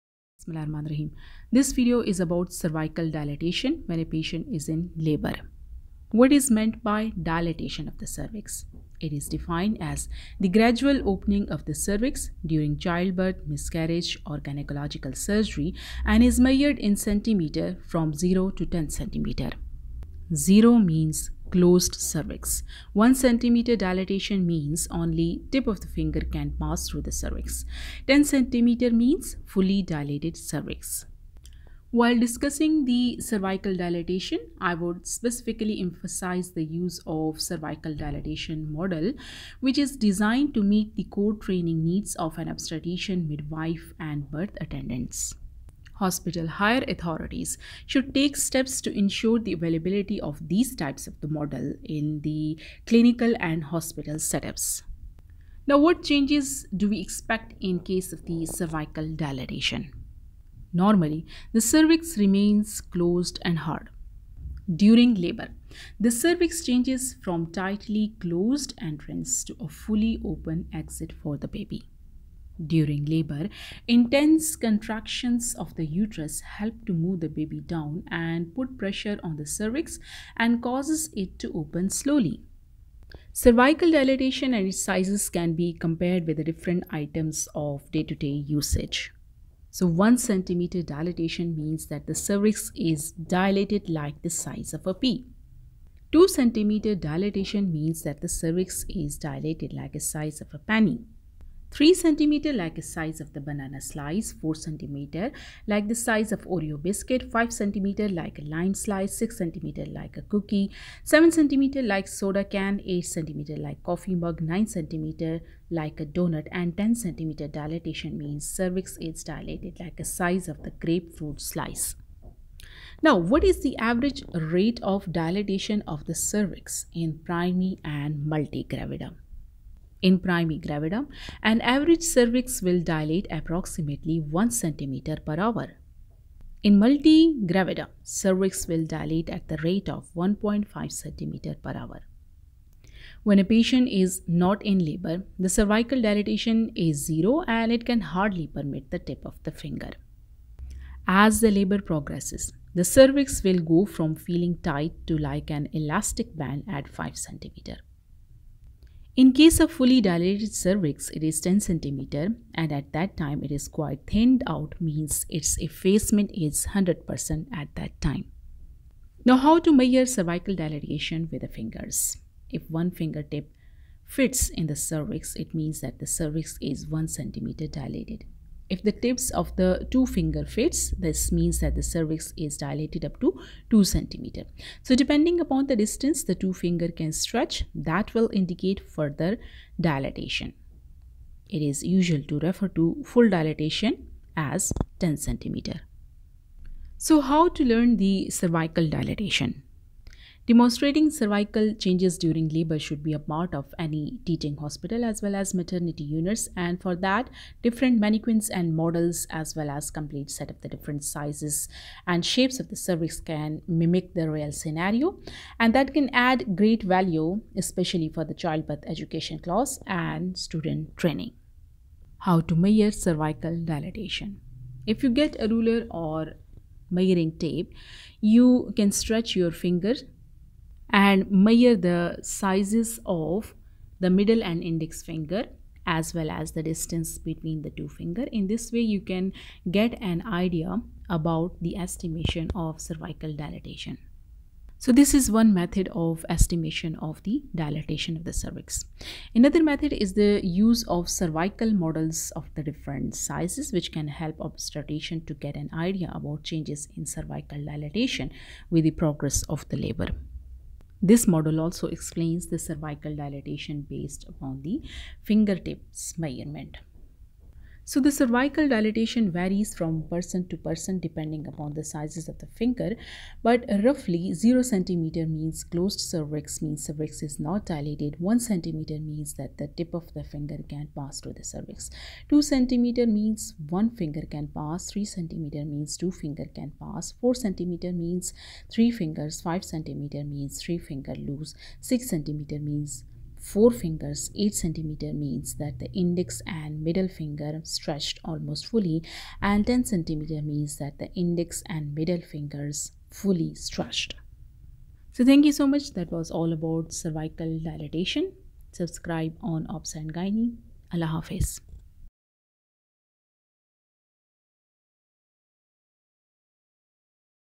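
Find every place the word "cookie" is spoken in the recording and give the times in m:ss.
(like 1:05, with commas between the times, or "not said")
1:50.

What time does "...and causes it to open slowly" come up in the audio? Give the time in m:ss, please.
1:20.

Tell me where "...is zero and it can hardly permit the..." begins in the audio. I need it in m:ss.
2:26.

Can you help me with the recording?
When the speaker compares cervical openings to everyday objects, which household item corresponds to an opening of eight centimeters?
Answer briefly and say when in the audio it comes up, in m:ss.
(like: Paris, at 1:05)
coffee mug, at 1:53.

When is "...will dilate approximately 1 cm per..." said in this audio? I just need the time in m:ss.
2:12.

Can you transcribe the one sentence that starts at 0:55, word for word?
Now, what changes do we expect in case of the cervical dilatation?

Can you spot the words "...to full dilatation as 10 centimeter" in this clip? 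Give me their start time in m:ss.
3:12.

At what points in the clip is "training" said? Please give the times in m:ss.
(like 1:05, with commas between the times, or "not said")
0:41, 3:40.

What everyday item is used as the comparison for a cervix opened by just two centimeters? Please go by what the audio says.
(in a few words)
penny.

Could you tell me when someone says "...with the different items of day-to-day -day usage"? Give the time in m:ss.
1:26.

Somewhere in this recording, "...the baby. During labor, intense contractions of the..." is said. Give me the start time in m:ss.
1:11.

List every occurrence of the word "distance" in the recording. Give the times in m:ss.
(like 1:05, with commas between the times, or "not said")
3:05, 3:56.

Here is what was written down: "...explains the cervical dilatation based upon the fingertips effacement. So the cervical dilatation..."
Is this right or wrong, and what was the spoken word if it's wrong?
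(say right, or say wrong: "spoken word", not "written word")
wrong: "measurement", not "effacement".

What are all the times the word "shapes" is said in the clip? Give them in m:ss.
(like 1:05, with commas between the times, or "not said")
3:32.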